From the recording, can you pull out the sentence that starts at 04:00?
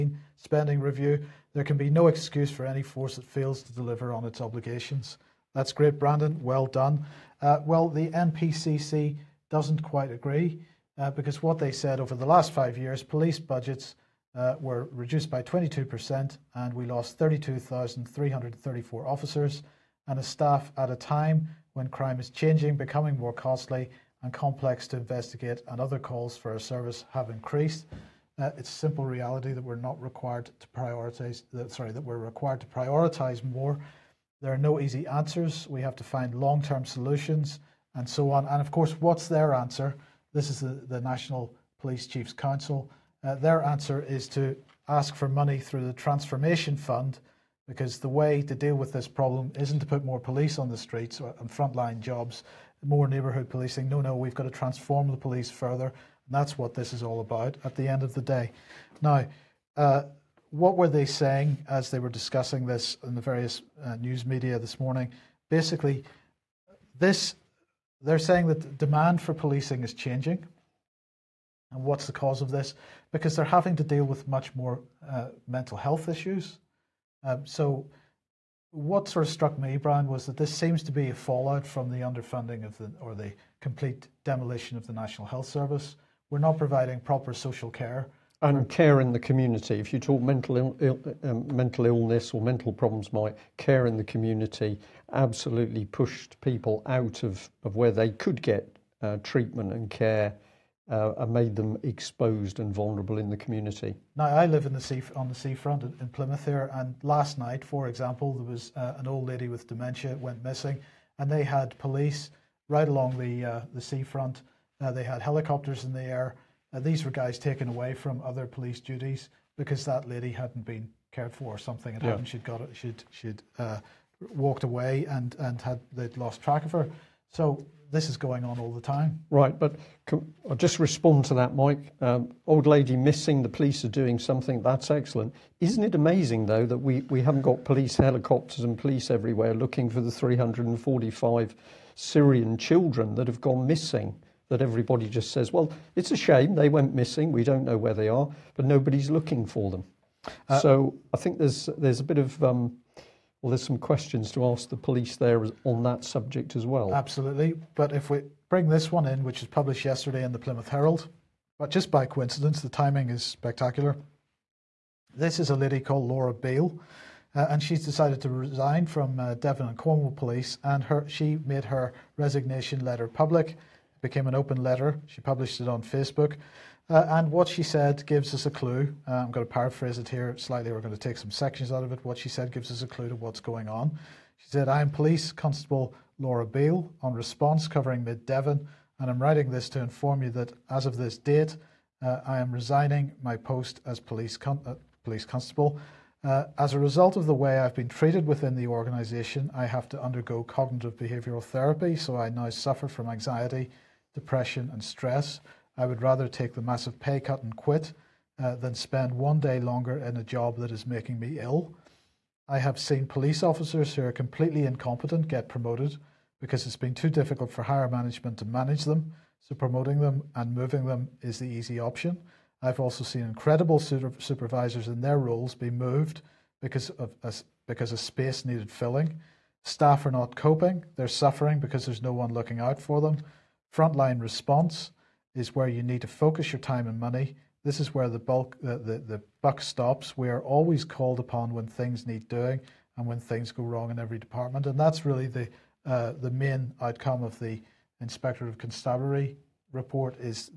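We are always called upon when things need doing and when things go wrong in every department.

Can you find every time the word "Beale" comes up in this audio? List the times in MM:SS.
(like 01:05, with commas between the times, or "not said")
02:46, 03:06.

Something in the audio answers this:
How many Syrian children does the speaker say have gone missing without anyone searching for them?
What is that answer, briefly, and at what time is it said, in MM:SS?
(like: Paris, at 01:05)
345, at 02:20.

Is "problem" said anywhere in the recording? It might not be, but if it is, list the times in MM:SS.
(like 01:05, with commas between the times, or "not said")
00:49, 01:32.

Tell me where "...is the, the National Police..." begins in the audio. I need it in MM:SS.
00:40.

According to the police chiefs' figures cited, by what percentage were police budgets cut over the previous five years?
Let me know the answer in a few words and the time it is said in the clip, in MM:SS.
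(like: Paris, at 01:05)
22%, at 00:15.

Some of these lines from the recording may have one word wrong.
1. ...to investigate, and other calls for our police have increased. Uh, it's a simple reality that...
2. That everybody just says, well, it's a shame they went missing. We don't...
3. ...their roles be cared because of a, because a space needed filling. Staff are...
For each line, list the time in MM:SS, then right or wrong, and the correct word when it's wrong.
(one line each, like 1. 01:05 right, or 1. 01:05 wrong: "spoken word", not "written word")
1. 00:24 wrong: "service", not "police"
2. 02:24 right
3. 03:45 wrong: "moved", not "cared".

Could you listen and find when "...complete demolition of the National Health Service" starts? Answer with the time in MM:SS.
01:23.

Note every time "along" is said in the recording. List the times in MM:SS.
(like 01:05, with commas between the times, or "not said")
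01:52.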